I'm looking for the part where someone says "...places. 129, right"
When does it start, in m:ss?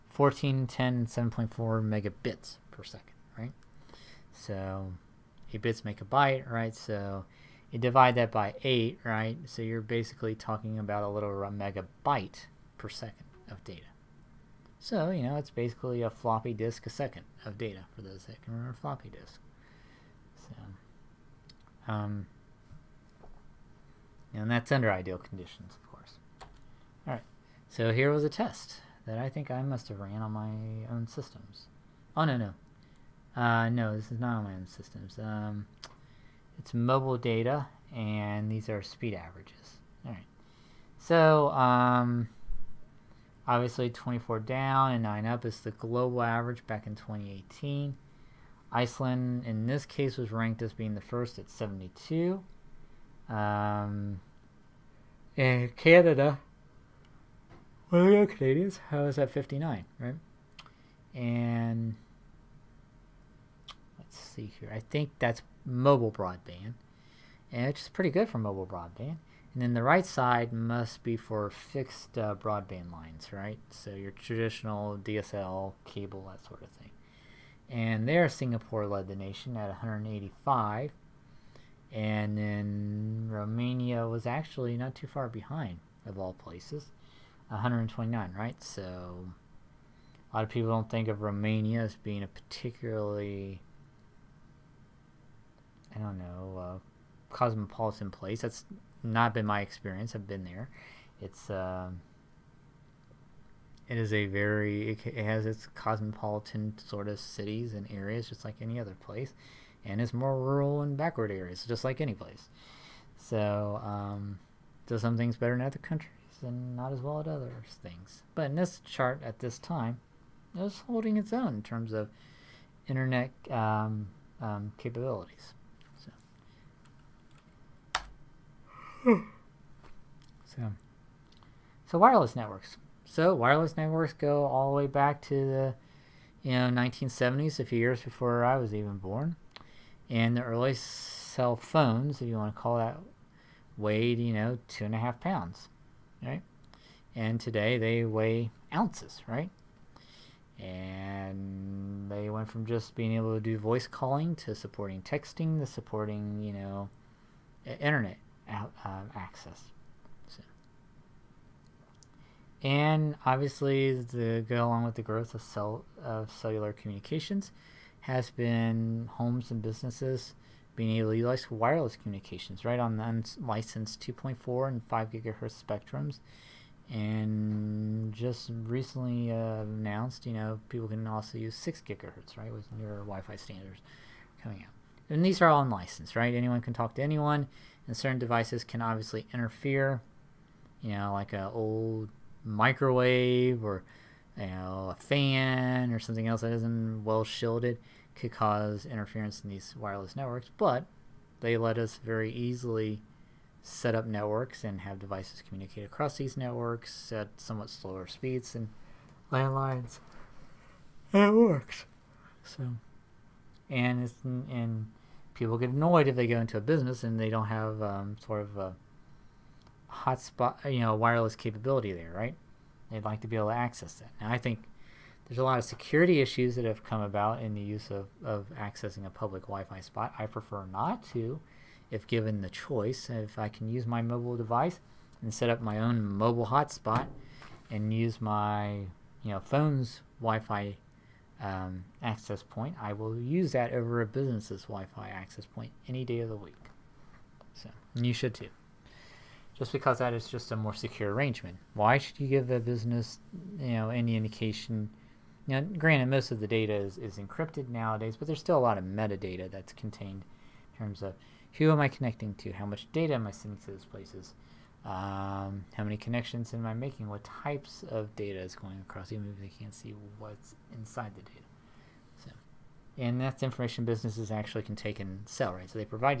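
1:26.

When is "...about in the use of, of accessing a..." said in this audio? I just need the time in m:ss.
3:47.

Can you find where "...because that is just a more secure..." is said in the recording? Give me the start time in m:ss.
4:09.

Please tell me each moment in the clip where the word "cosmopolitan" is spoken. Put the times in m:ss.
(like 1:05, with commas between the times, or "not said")
1:37, 1:45.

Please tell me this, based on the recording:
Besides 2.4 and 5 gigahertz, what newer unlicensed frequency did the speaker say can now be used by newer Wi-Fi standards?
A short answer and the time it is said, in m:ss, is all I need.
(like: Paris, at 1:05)
6 gigahertz, at 3:01.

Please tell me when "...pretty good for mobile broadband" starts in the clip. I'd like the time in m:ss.
1:07.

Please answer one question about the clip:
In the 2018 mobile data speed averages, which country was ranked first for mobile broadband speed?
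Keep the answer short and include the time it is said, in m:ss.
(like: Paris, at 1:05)
Iceland, at 0:48.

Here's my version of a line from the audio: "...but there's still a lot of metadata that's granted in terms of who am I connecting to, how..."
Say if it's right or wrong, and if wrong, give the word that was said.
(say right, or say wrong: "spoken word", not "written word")
wrong: "contained", not "granted".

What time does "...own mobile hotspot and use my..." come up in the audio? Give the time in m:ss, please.
3:55.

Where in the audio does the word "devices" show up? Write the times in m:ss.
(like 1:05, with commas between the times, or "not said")
3:08, 3:24, 3:54.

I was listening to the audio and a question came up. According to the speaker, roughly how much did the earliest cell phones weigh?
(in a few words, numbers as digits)
2.5 pounds.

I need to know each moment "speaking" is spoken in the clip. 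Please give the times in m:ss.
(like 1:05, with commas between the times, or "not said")
not said.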